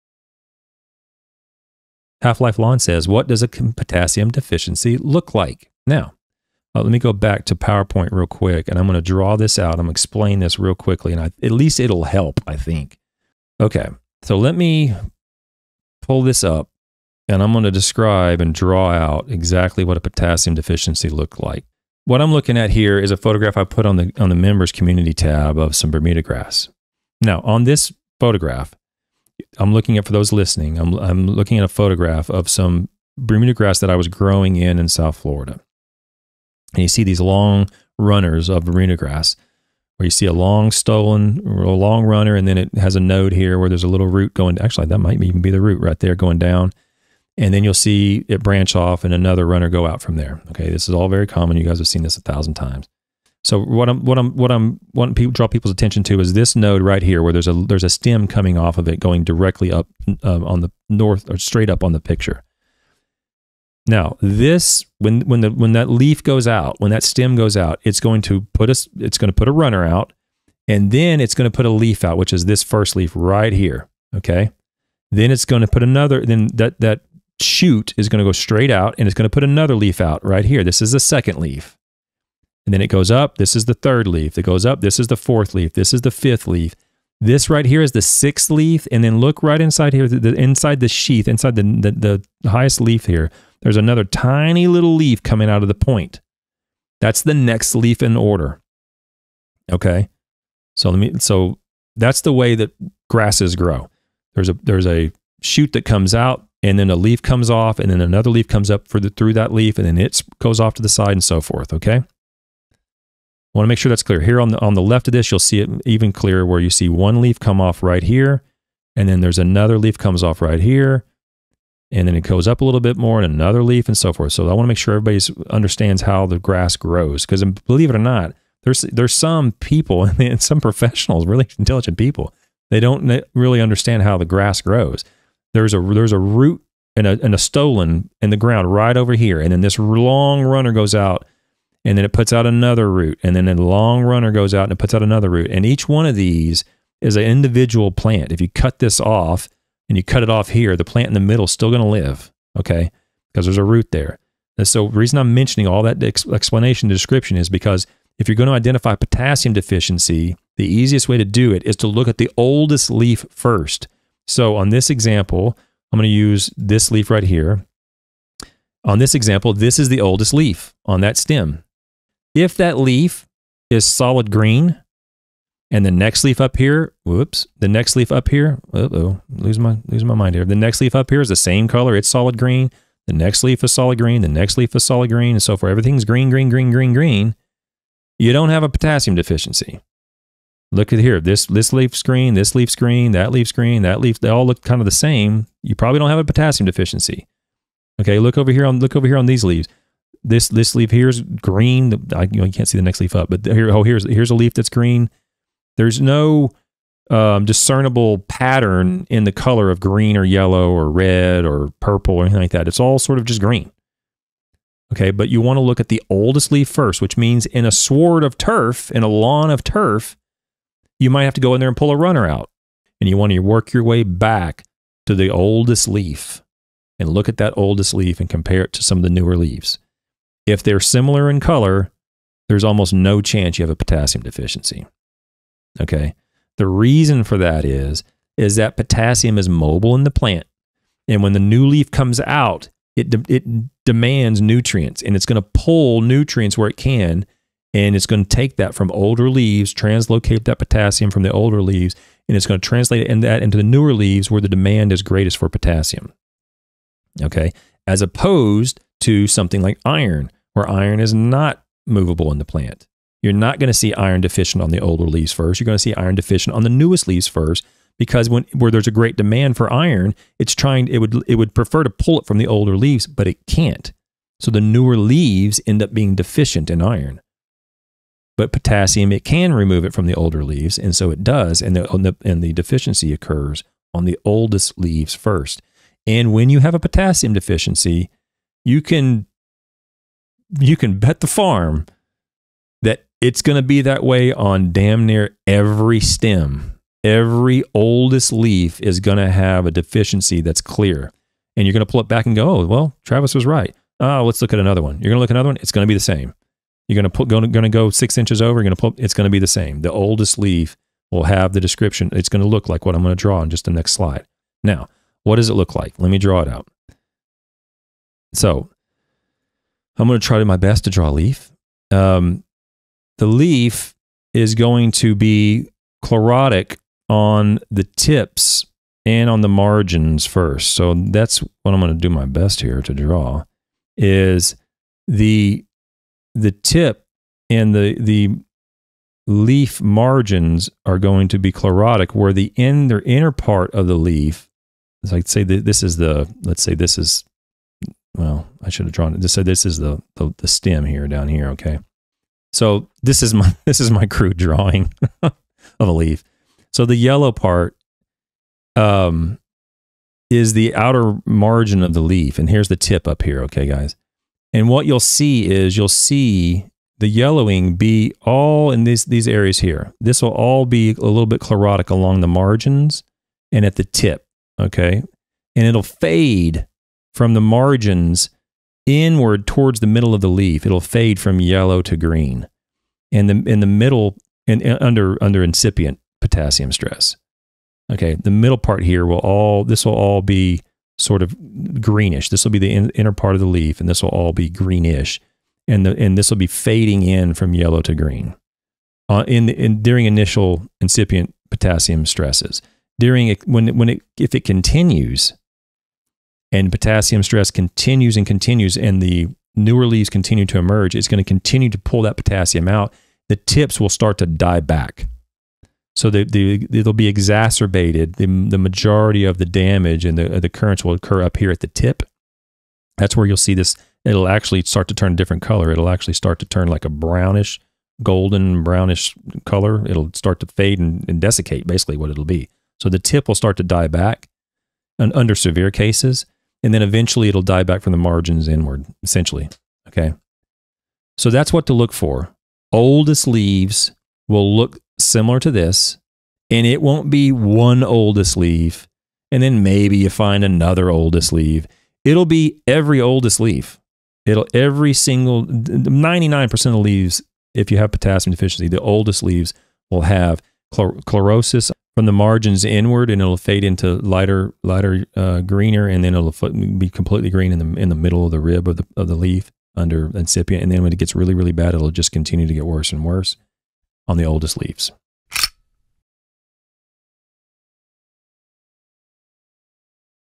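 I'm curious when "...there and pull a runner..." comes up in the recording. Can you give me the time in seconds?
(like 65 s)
221 s.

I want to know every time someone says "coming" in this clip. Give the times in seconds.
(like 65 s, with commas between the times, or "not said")
58 s, 95 s.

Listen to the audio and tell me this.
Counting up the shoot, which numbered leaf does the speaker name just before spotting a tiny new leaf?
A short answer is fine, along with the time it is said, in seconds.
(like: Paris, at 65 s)
sixth, at 88 s.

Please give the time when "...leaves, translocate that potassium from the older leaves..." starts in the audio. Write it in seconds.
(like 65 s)
249 s.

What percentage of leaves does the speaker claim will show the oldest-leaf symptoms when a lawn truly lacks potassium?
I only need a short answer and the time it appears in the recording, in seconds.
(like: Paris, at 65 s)
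99%, at 455 s.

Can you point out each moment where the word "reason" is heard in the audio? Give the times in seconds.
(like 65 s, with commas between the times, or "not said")
154 s, 236 s.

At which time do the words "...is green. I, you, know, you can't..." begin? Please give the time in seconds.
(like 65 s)
201 s.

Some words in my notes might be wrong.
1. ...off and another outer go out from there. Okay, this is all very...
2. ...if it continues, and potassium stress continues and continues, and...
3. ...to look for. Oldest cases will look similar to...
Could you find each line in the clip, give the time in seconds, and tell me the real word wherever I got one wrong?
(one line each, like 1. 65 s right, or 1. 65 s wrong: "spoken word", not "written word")
1. 48 s wrong: "runner", not "outer"
2. 404 s right
3. 441 s wrong: "leaves", not "cases".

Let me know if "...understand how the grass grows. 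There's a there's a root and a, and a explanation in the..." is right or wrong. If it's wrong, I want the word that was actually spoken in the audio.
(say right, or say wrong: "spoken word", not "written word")
wrong: "stolon", not "explanation".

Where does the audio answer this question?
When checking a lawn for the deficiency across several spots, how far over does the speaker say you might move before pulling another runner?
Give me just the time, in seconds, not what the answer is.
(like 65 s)
307 s.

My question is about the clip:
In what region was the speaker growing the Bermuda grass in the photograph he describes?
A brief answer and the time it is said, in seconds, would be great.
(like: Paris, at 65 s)
South Florida, at 34 s.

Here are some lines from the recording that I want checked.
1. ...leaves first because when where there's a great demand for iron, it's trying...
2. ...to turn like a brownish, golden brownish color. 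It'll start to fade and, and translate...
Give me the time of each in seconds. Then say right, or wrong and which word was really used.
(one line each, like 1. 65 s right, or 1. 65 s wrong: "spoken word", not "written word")
1. 267 s right
2. 426 s wrong: "desiccate", not "translate".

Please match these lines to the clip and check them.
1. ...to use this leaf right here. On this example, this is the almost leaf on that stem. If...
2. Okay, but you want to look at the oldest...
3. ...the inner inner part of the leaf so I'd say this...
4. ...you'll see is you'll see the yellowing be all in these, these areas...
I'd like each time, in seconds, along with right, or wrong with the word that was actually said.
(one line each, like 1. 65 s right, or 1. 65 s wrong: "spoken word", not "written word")
1. 166 s wrong: "oldest", not "almost"
2. 214 s right
3. 342 s right
4. 364 s right.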